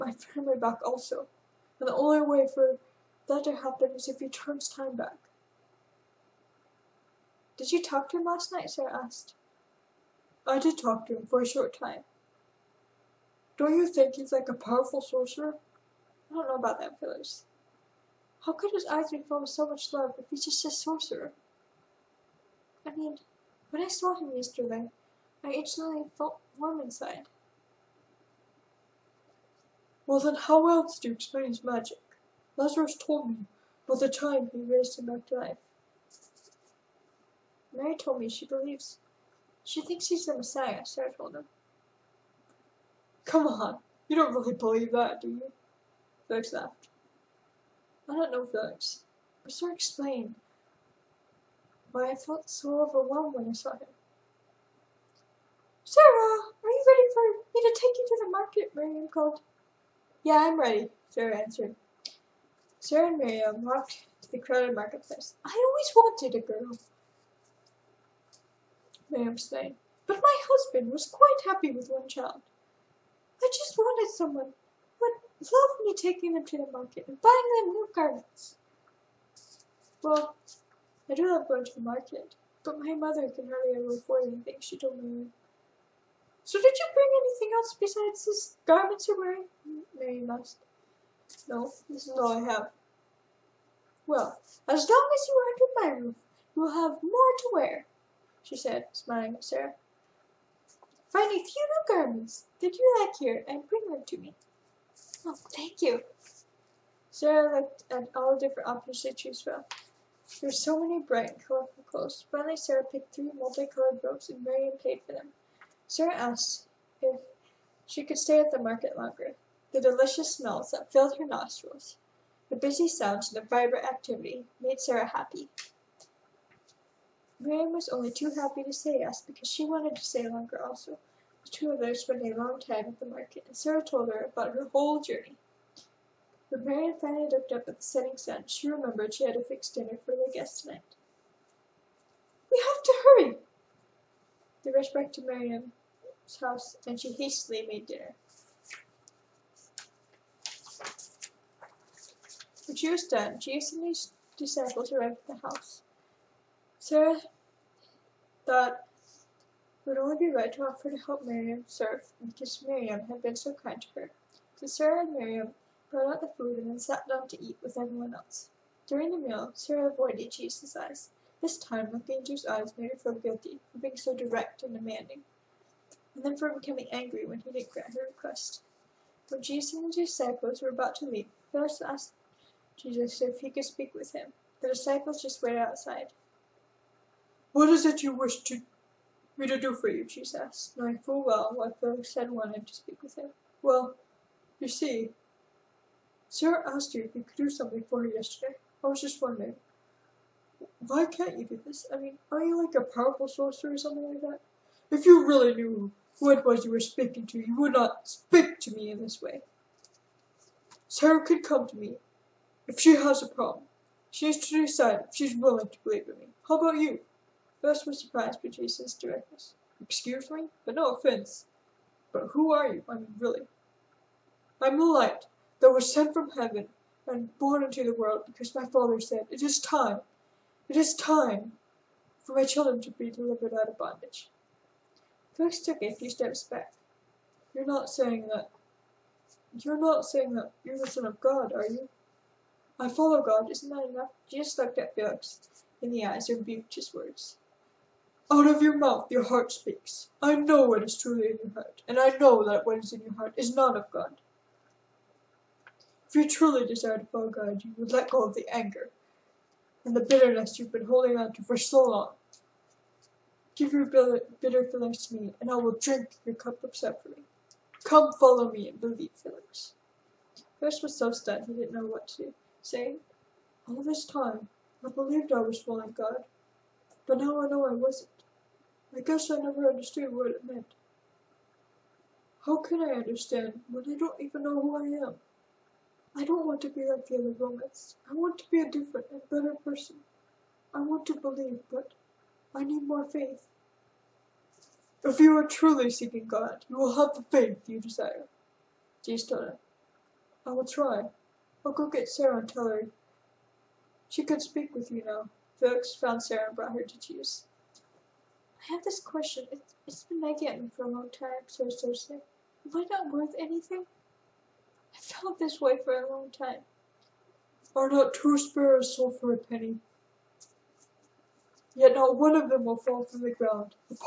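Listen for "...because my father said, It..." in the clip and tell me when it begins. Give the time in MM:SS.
03:48.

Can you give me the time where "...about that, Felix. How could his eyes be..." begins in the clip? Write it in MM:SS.
00:16.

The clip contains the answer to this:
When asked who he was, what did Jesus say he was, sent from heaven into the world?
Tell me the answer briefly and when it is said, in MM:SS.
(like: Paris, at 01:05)
the light, at 03:44.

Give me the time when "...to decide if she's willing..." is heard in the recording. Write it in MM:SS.
03:34.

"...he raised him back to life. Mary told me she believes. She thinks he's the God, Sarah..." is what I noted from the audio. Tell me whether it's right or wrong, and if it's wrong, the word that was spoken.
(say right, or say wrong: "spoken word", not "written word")
wrong: "Messiah", not "God".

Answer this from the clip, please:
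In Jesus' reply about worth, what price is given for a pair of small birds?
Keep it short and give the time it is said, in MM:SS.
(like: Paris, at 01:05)
a penny, at 05:19.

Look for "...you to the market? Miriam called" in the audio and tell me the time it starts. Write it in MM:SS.
00:57.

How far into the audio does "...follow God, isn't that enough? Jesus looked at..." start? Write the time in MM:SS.
04:02.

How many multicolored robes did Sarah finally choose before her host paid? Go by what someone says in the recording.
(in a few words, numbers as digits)
3.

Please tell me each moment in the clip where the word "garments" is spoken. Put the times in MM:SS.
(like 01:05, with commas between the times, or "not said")
01:17, 01:28, 01:41.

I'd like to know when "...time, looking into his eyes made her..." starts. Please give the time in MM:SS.
02:51.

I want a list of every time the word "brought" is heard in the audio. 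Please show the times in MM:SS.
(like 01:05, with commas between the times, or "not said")
02:45, 05:06.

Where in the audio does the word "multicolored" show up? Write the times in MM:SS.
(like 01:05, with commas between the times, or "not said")
01:53.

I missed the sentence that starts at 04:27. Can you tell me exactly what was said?
Come follow me and believe, Felix.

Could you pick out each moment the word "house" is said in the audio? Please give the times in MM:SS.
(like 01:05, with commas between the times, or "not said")
02:26, 02:35.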